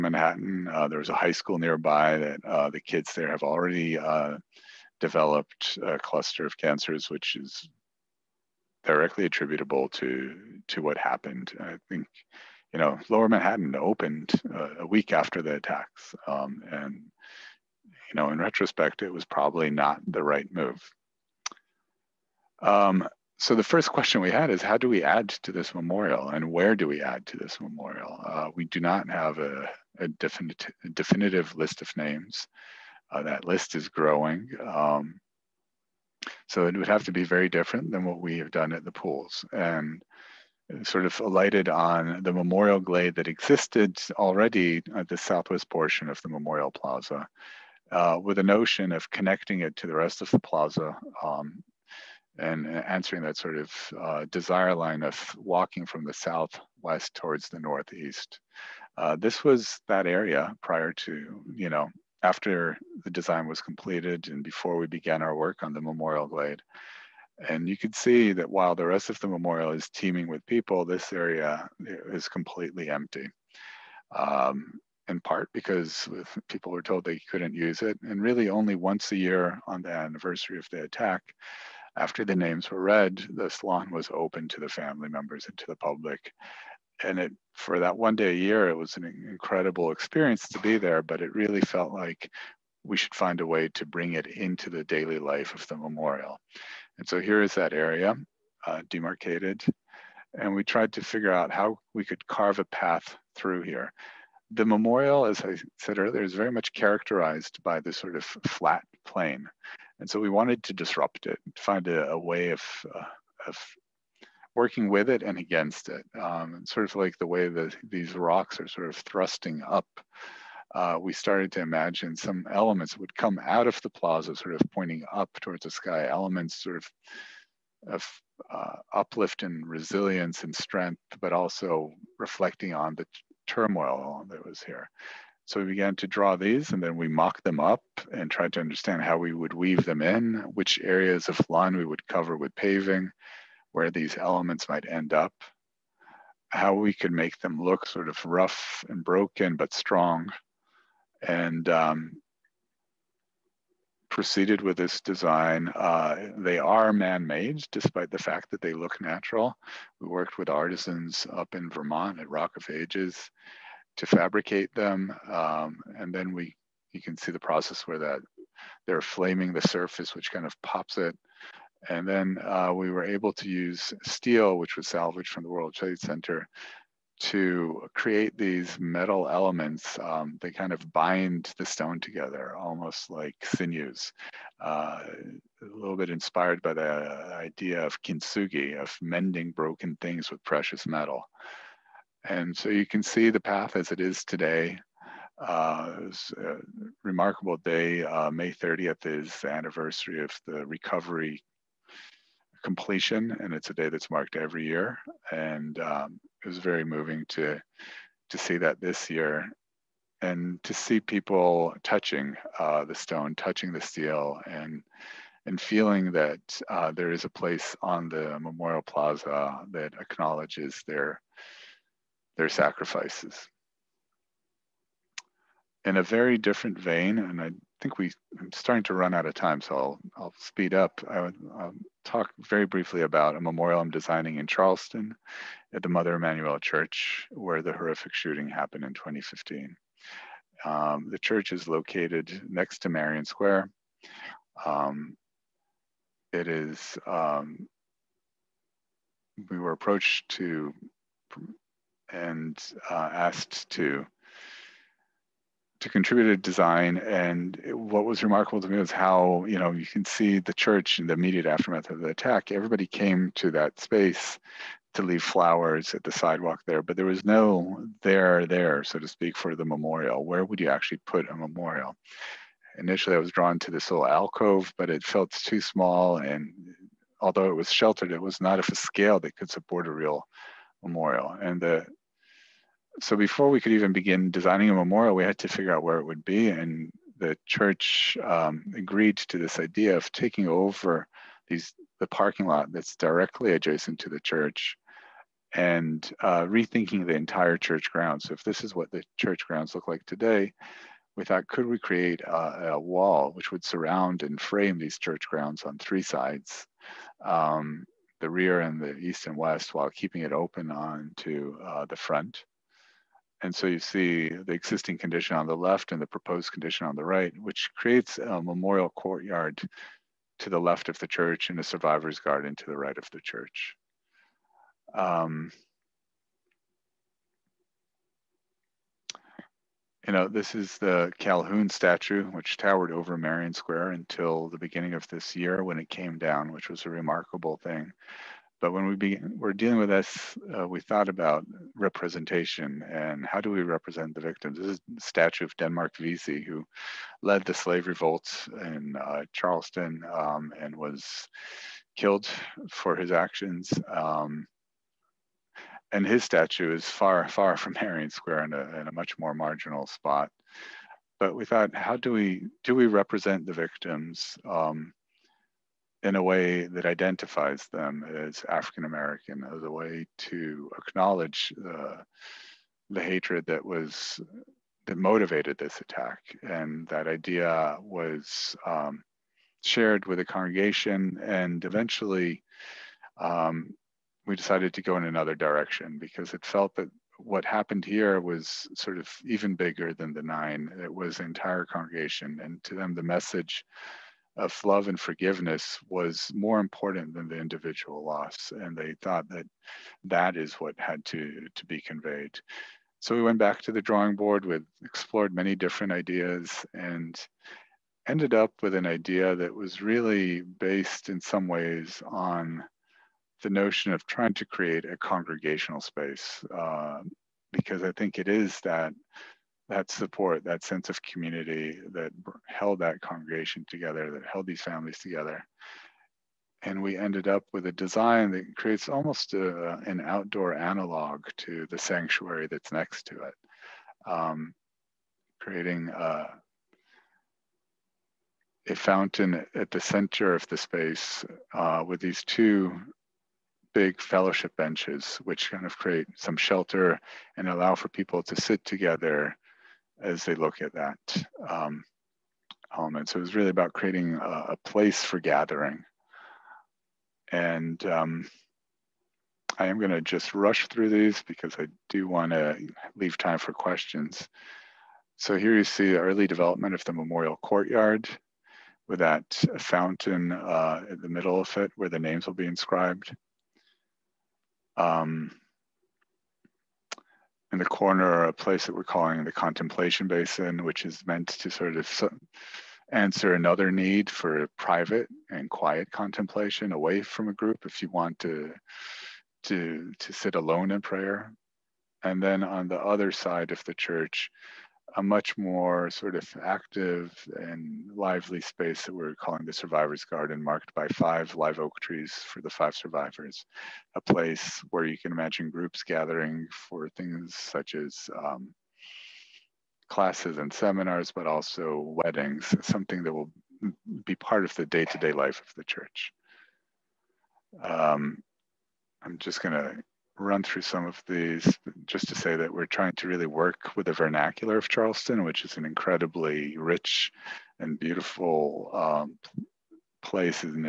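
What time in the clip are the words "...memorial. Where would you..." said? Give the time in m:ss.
4:29.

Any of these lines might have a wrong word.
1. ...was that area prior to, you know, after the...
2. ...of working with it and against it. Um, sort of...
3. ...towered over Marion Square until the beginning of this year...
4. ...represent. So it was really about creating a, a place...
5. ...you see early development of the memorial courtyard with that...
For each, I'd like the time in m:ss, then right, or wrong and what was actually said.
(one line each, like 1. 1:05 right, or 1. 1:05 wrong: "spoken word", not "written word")
1. 0:59 right
2. 1:53 right
3. 5:32 right
4. 7:32 wrong: "element", not "represent"
5. 7:45 right.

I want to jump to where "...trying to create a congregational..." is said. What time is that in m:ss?
6:54.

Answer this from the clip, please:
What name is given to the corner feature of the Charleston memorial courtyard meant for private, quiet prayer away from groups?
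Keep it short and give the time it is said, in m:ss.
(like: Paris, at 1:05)
Contemplation basin, at 7:59.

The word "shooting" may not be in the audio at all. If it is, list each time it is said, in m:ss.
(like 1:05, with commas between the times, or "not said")
3:58.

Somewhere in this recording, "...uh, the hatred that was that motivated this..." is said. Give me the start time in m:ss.
6:11.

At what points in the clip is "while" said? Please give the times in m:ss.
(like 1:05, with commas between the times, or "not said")
1:08, 5:09.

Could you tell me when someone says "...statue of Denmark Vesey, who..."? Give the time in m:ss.
5:45.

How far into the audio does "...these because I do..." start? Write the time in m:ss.
7:40.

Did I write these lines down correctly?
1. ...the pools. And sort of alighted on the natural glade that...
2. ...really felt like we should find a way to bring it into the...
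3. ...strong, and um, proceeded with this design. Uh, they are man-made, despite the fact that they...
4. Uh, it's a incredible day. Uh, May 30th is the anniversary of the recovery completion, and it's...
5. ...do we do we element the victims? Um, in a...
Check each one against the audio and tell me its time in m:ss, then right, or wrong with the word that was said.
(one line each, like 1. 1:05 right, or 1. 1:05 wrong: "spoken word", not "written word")
1. 0:38 wrong: "memorial", not "natural"
2. 1:31 right
3. 2:29 right
4. 3:15 wrong: "remarkable", not "incredible"
5. 6:01 wrong: "represent", not "element".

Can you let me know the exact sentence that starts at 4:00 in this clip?
Um, the church is located next to Marion Square.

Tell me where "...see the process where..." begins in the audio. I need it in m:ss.
2:47.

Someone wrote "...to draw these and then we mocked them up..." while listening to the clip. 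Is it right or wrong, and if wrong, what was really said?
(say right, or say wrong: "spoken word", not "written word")
right.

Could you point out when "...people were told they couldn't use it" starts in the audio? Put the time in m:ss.
1:16.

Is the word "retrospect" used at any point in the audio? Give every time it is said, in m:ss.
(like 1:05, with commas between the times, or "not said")
0:18.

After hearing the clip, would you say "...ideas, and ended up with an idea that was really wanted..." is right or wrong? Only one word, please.
wrong.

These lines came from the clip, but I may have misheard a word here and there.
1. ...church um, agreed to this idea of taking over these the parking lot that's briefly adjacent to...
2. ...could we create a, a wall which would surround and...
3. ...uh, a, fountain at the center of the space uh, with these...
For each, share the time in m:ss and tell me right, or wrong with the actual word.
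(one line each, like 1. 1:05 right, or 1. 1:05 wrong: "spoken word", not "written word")
1. 4:47 wrong: "directly", not "briefly"
2. 5:01 right
3. 7:15 right.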